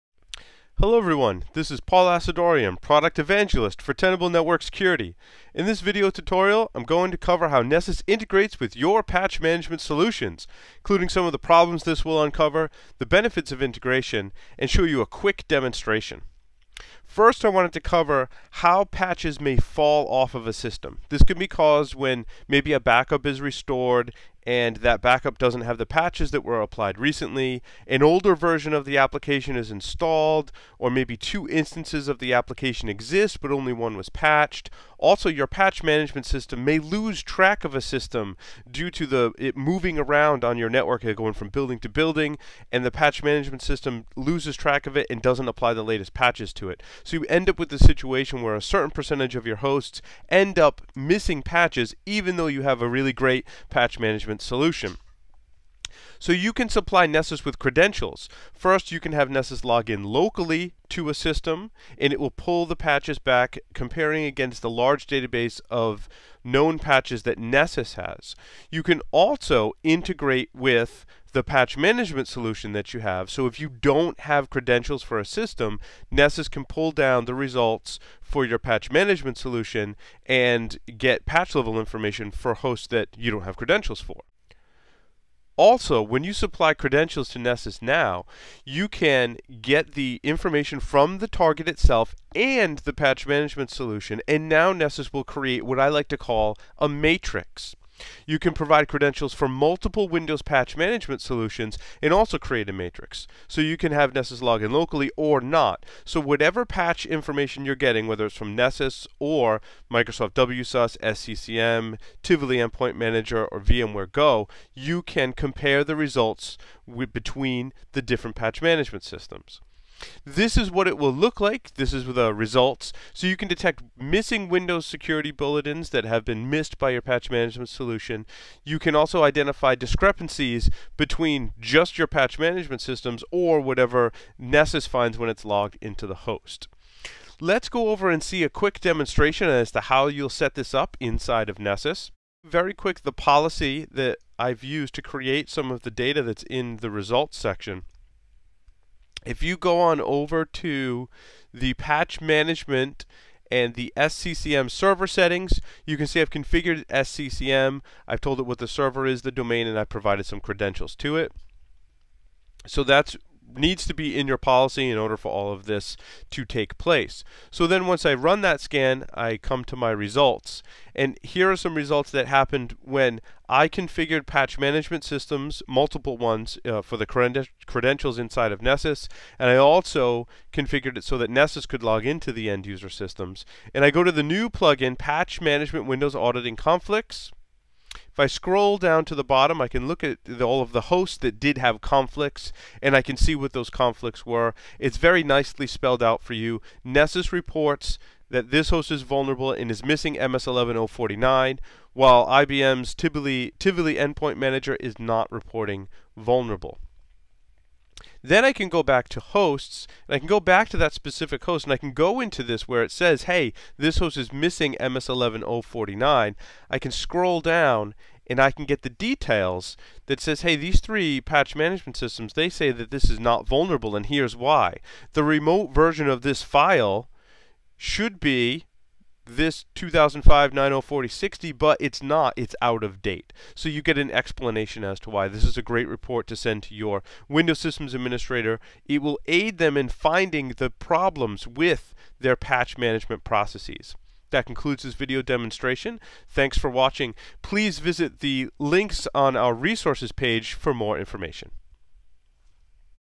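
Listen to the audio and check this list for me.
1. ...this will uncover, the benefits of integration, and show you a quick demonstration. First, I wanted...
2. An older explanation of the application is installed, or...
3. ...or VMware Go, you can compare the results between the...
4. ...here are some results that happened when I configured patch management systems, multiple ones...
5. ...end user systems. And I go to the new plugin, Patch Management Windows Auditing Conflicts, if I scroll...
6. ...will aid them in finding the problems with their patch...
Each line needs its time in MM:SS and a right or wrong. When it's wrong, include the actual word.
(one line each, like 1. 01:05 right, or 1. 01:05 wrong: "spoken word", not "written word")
1. 00:11 right
2. 00:27 wrong: "version", not "explanation"
3. 01:53 right
4. 02:51 right
5. 03:02 right
6. 03:59 right.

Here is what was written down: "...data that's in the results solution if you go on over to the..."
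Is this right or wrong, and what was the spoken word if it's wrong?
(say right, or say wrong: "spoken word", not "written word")
wrong: "section", not "solution".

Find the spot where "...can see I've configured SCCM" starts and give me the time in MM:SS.
02:35.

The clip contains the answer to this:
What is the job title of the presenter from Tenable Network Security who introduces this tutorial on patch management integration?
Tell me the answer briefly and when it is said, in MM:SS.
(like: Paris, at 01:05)
Product Evangelist, at 00:02.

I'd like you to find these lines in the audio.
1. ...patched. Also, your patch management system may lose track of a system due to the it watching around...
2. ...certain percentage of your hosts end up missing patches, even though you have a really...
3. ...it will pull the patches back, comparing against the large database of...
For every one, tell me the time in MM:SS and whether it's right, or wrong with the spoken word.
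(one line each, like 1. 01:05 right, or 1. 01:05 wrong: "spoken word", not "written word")
1. 00:34 wrong: "moving", not "watching"
2. 00:48 right
3. 01:02 right.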